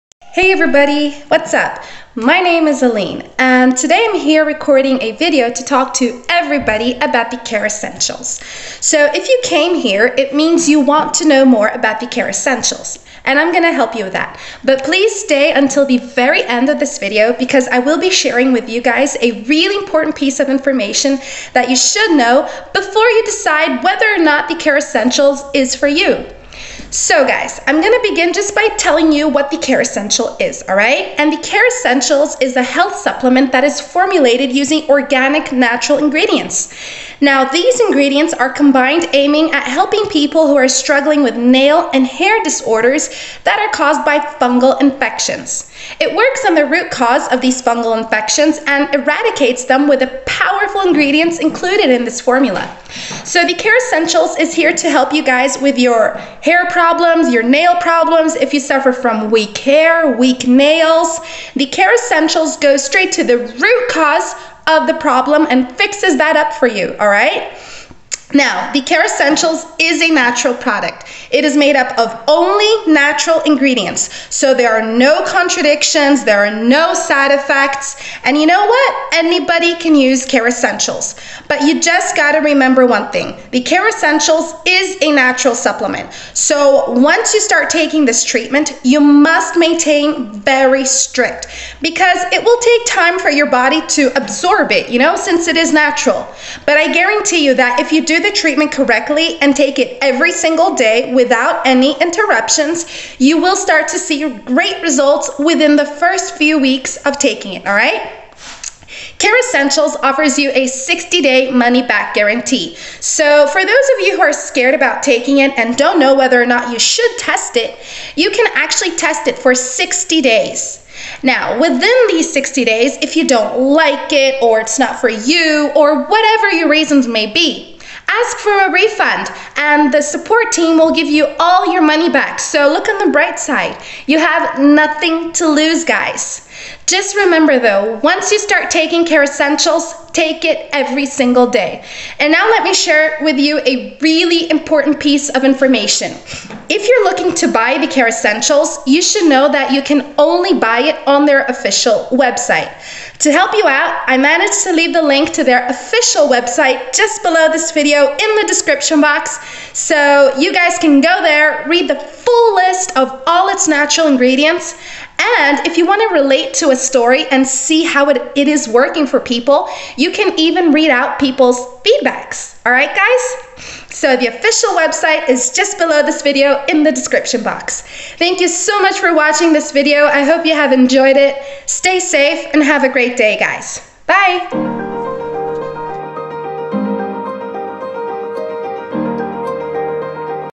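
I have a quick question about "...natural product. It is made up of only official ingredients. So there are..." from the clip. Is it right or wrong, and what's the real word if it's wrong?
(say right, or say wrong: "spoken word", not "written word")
wrong: "natural", not "official".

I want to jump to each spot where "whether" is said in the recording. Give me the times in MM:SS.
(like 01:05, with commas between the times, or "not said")
00:23, 01:56.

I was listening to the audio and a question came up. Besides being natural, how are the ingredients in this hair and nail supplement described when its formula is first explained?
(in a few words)
organic.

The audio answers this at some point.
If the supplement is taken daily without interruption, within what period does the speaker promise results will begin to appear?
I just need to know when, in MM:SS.
01:45.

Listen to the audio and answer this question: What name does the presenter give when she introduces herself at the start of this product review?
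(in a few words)
Aline.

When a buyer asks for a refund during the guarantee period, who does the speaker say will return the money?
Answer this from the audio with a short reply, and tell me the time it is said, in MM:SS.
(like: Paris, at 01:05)
the support team, at 02:10.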